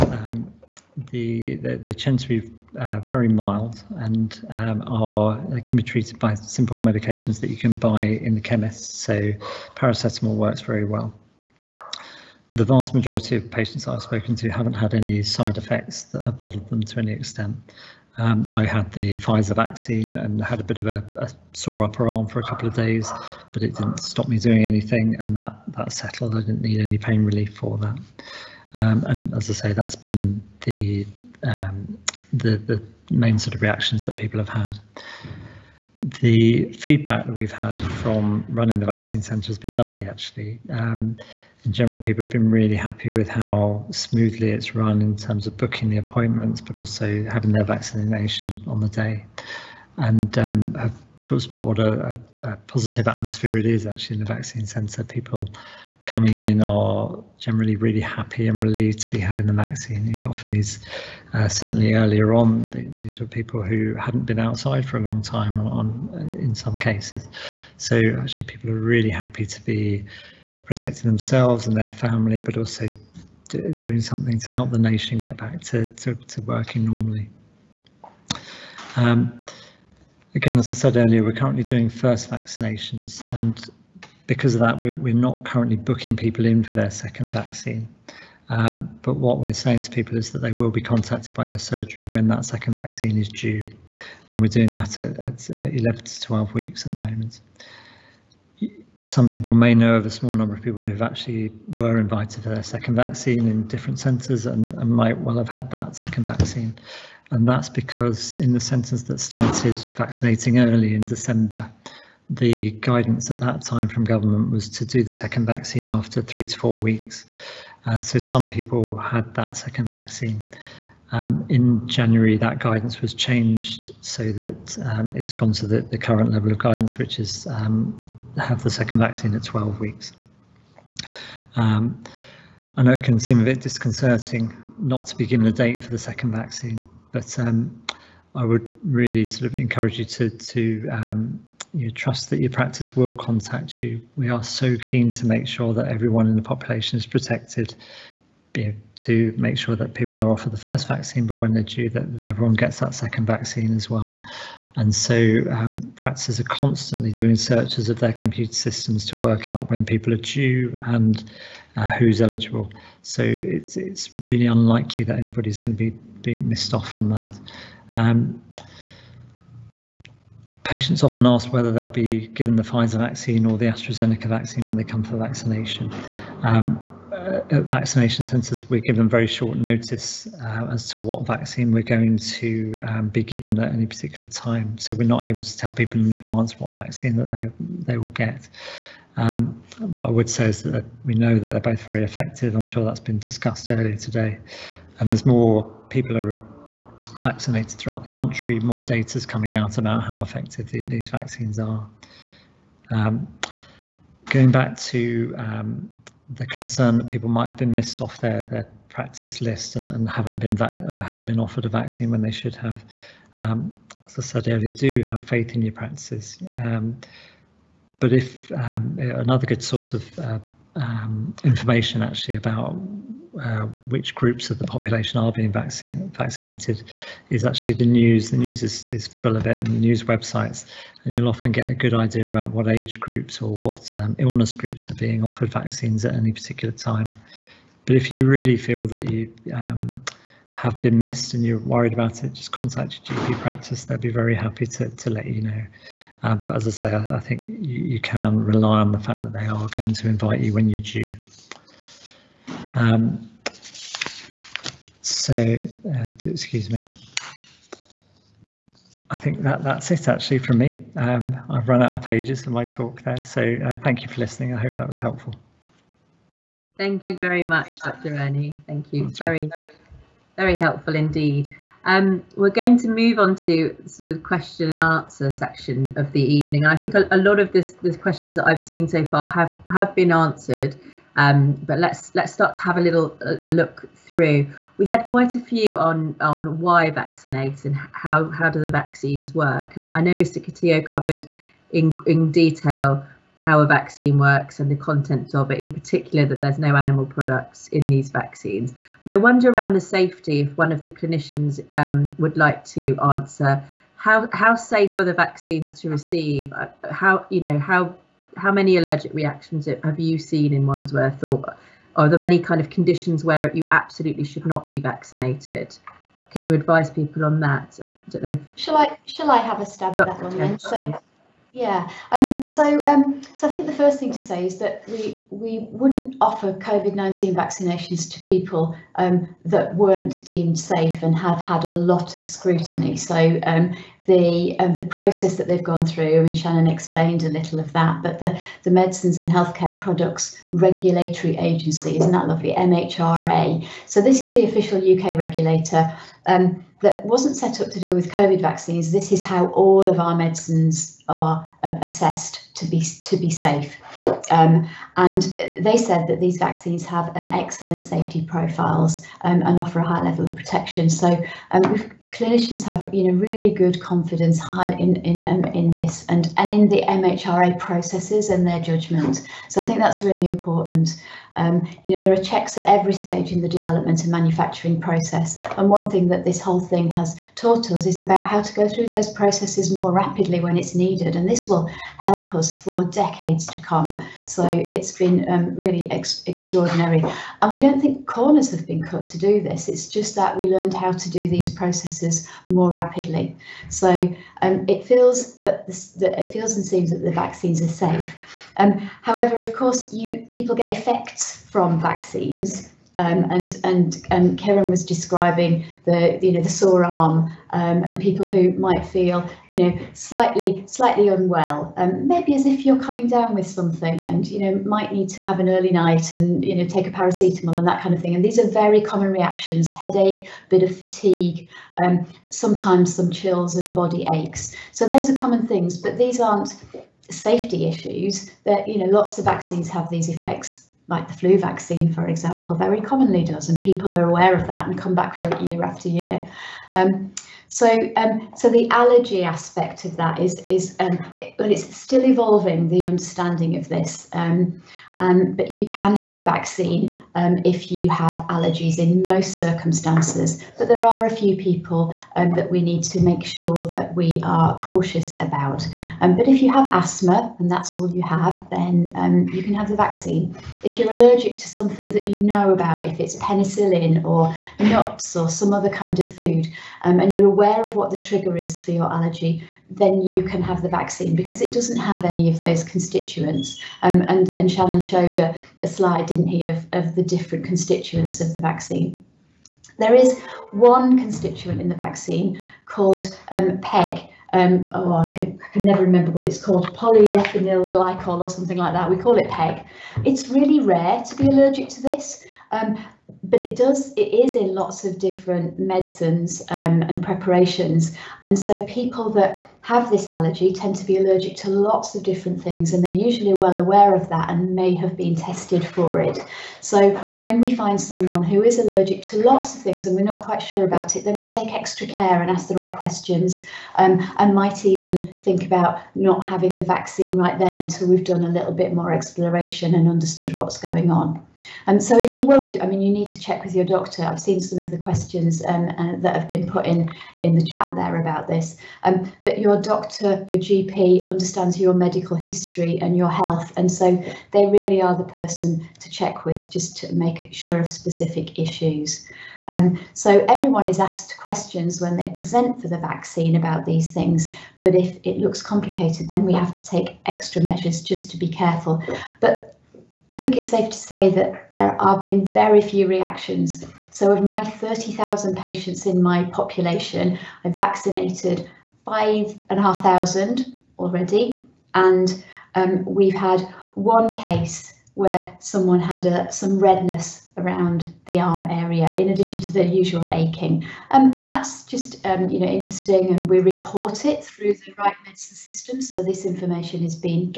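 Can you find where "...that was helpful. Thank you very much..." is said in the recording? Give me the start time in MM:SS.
04:24.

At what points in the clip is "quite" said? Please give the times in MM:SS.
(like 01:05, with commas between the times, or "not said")
04:45, 08:30.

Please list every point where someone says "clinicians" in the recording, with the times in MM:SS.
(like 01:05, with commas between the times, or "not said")
05:00, 06:02.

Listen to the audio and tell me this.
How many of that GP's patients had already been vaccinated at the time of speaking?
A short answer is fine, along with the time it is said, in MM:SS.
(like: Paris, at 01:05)
5,500, at 09:18.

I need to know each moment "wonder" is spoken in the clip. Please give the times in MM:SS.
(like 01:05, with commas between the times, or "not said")
04:59.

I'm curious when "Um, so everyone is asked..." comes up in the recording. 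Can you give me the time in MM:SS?
08:59.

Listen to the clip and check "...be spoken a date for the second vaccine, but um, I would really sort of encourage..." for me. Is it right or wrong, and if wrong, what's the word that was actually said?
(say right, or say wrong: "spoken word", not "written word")
wrong: "given", not "spoken".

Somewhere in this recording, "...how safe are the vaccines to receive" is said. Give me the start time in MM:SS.
05:04.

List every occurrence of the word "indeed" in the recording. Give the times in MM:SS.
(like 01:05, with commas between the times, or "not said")
04:30.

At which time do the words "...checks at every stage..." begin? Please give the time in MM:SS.
06:12.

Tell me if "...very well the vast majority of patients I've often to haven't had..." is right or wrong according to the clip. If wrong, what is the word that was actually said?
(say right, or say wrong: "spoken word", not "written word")
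wrong: "spoken", not "often".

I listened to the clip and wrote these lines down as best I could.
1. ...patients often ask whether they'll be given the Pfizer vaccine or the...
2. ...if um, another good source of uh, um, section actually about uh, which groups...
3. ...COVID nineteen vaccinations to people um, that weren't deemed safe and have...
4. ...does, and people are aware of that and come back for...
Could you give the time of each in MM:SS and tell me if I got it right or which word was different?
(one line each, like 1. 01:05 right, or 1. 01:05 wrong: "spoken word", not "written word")
1. 02:50 right
2. 03:38 wrong: "information", not "section"
3. 05:26 right
4. 07:13 right.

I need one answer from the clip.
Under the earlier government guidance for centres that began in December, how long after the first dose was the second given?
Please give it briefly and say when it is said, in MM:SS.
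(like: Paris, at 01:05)
3 to 4 weeks, at 01:56.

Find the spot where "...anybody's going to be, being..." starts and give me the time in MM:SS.
02:45.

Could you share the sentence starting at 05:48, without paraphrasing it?
This is how all of our medicines are uh, assessed to be to be safe.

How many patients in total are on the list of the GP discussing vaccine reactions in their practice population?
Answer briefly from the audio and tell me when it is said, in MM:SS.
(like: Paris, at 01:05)
30,000, at 09:14.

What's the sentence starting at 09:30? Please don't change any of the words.
Um, and that's just um, you know interesting and we report it through the right medicine system.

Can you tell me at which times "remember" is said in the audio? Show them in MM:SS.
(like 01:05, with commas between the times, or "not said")
08:05.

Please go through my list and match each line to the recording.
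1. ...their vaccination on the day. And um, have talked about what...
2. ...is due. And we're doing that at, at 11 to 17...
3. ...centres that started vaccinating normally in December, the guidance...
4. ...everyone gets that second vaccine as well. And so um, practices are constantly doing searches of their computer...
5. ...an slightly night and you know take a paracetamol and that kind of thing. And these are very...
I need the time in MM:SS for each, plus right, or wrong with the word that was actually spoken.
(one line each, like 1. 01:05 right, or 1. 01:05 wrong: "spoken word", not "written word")
1. 00:47 right
2. 01:33 wrong: "12", not "17"
3. 01:48 wrong: "early", not "normally"
4. 02:32 right
5. 06:55 wrong: "early", not "slightly".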